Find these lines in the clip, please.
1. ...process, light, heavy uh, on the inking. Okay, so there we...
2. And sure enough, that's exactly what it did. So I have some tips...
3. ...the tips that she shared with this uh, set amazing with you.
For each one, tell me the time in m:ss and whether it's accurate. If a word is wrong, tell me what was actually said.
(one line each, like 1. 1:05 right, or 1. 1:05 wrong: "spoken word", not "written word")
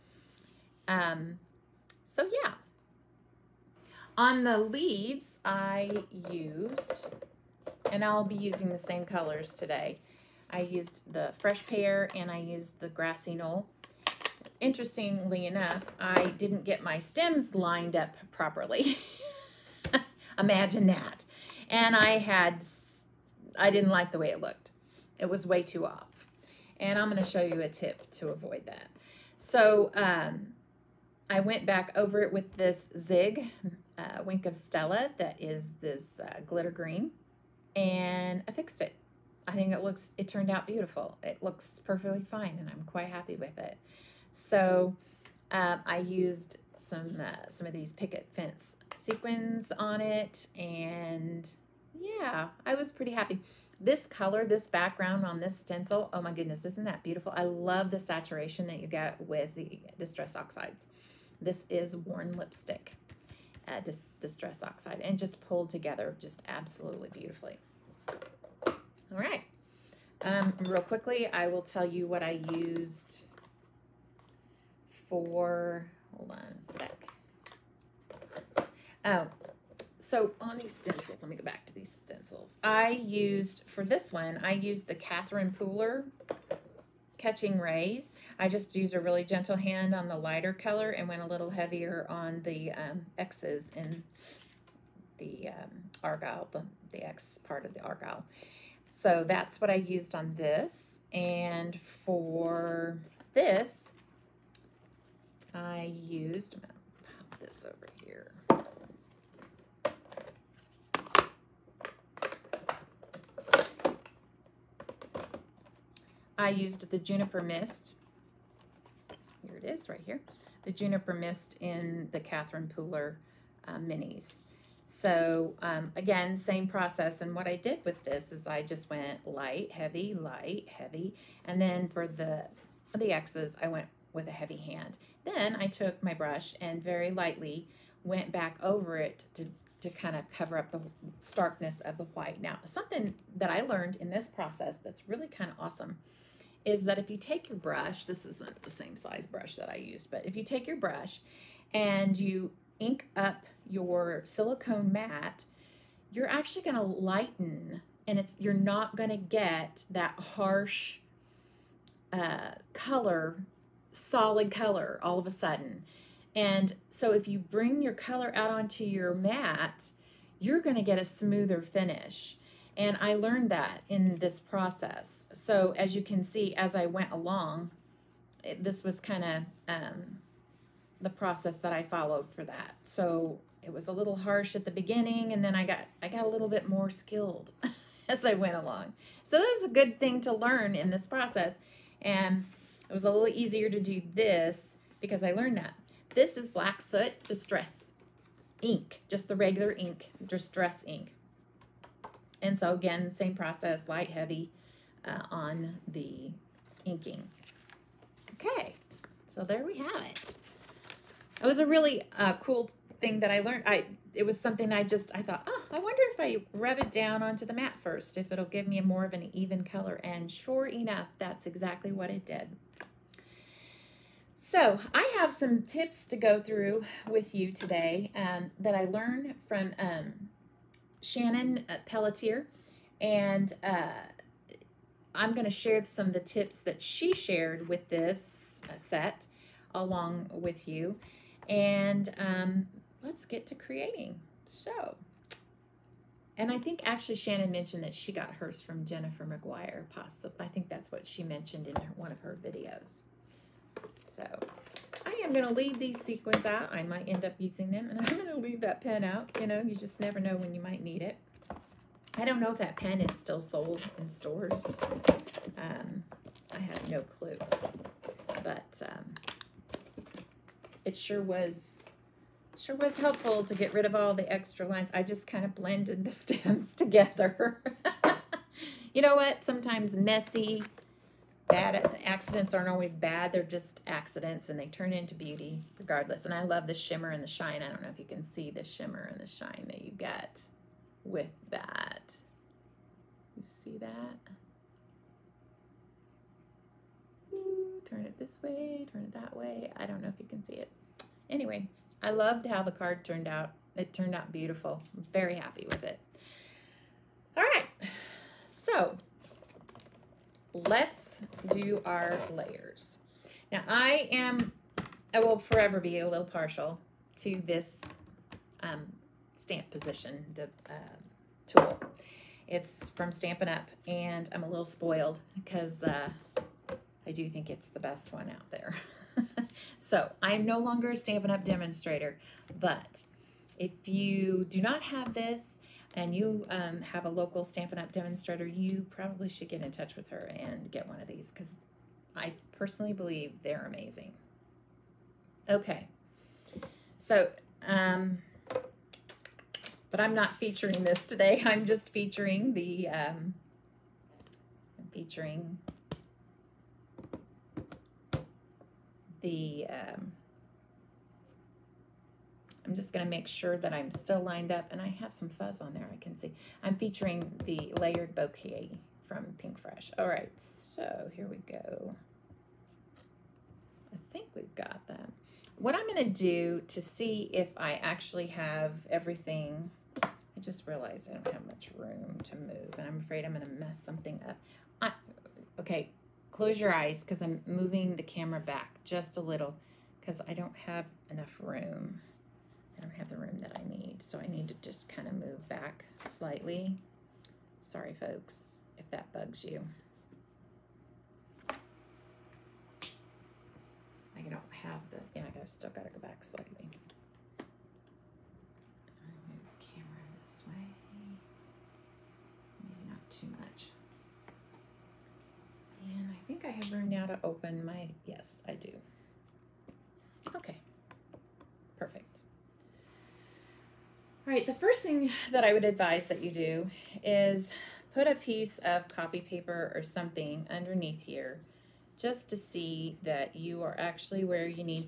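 1. 3:23 right
2. 3:40 right
3. 3:56 wrong: "along", not "amazing".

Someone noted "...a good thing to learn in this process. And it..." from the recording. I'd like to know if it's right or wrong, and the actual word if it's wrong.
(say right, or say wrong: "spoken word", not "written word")
right.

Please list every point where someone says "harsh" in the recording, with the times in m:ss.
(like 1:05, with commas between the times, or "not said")
2:40, 3:04.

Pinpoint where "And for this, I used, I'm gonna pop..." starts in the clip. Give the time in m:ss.
1:41.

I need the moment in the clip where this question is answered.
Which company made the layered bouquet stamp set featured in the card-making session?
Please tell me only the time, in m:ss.
6:09.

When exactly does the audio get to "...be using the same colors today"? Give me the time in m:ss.
0:08.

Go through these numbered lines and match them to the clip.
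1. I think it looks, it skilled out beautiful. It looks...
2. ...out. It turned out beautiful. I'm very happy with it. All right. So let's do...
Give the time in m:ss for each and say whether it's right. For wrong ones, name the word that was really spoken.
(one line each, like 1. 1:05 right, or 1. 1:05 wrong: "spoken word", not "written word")
1. 0:39 wrong: "turned", not "skilled"
2. 5:03 right.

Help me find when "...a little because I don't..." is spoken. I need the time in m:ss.
6:29.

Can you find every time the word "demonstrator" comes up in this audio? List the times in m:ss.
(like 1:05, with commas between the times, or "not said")
5:31, 5:37.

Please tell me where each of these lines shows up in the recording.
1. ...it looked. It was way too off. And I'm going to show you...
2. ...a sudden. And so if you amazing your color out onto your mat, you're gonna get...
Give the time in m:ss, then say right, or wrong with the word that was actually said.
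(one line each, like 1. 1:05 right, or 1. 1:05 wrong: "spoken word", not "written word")
1. 0:24 right
2. 2:45 wrong: "bring", not "amazing".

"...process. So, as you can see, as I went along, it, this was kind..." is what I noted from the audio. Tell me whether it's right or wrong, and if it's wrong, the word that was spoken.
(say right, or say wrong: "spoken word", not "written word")
right.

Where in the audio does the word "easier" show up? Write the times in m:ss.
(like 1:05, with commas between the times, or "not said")
3:13.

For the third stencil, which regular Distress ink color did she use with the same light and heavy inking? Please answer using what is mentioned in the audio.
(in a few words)
Black Soot.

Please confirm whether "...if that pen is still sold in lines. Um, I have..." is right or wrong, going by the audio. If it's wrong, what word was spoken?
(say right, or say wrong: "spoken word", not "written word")
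wrong: "stores", not "lines".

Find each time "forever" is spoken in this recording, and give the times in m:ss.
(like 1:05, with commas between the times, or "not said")
5:15.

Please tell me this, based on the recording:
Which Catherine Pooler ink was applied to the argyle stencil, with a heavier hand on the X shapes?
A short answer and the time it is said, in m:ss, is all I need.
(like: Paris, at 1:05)
Catching Rays, at 1:27.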